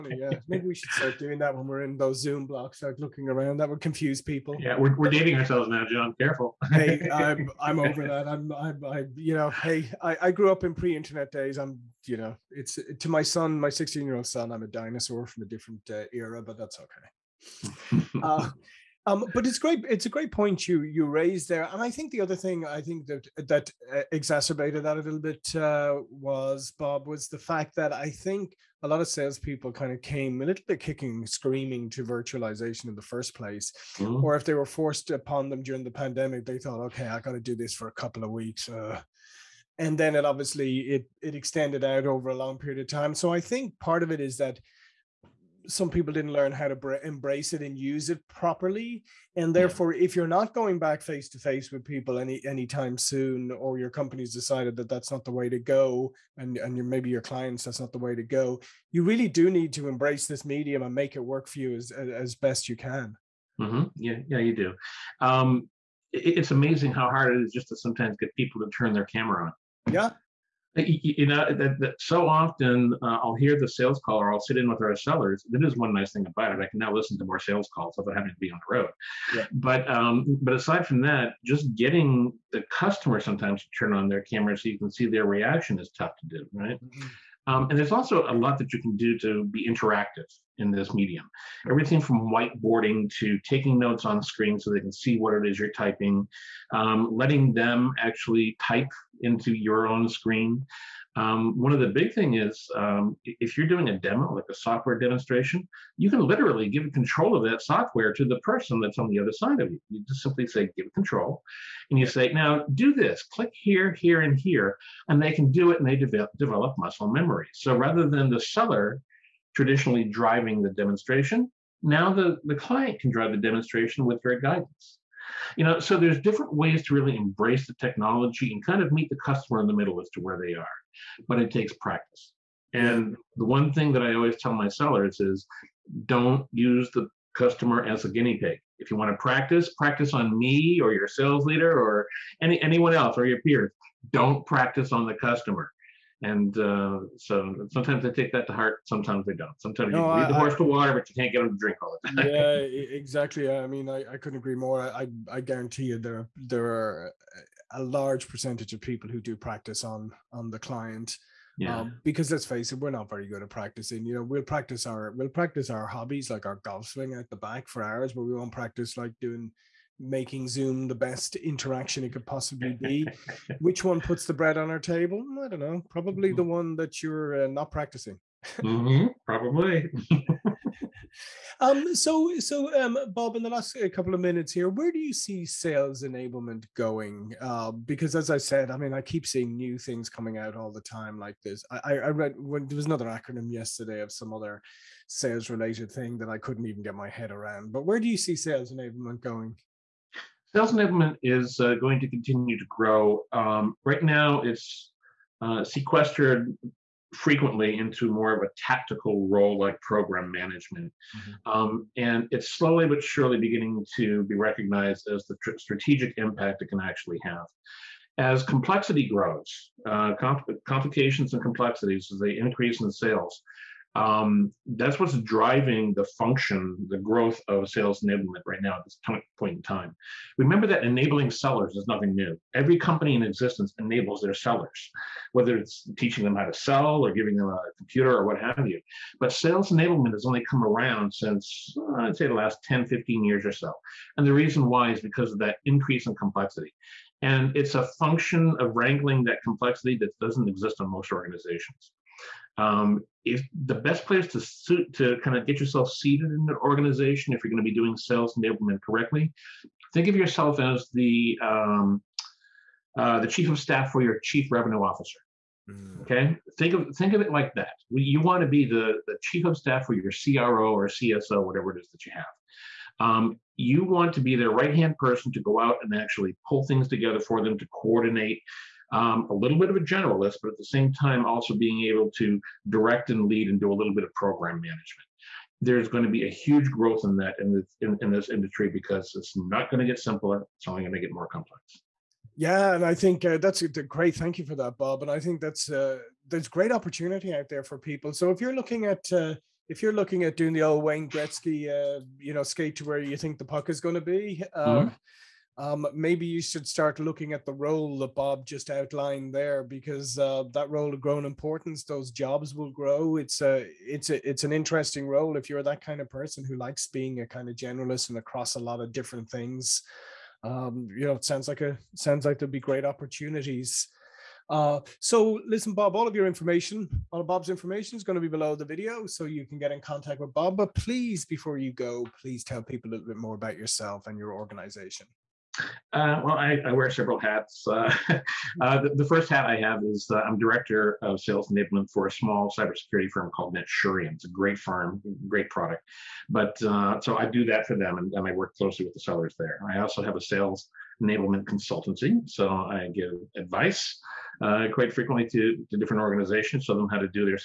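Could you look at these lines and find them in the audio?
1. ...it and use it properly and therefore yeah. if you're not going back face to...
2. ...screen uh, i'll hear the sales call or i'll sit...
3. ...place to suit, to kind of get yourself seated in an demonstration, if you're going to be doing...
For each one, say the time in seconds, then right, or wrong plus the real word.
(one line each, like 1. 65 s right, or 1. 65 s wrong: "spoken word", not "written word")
1. 47 s right
2. 72 s wrong: "often", not "screen"
3. 254 s wrong: "organization", not "demonstration".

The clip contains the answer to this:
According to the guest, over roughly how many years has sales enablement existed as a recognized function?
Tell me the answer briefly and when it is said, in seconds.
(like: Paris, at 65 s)
10 to 15 years, at 242 s.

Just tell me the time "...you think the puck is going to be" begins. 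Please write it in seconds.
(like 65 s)
302 s.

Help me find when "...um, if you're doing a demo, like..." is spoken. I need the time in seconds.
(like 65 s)
102 s.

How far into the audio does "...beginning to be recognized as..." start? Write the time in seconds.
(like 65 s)
213 s.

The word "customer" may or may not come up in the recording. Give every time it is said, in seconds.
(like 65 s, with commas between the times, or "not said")
82 s, 129 s, 137 s, 145 s.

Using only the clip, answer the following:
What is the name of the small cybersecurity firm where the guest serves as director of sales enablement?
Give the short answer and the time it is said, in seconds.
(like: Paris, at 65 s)
Netsurion, at 343 s.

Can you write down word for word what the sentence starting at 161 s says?
Um, because let's face it, we're not very good at practicing.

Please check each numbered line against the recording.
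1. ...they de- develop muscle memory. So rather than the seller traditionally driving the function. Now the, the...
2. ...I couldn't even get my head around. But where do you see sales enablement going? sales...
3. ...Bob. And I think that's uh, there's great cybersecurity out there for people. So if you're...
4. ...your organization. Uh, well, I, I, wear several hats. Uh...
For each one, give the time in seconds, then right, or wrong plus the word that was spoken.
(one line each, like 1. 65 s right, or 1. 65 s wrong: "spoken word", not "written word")
1. 115 s wrong: "demonstration", not "function"
2. 196 s right
3. 294 s wrong: "opportunity", not "cybersecurity"
4. 334 s right.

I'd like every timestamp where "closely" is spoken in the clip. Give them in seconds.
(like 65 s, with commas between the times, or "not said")
348 s.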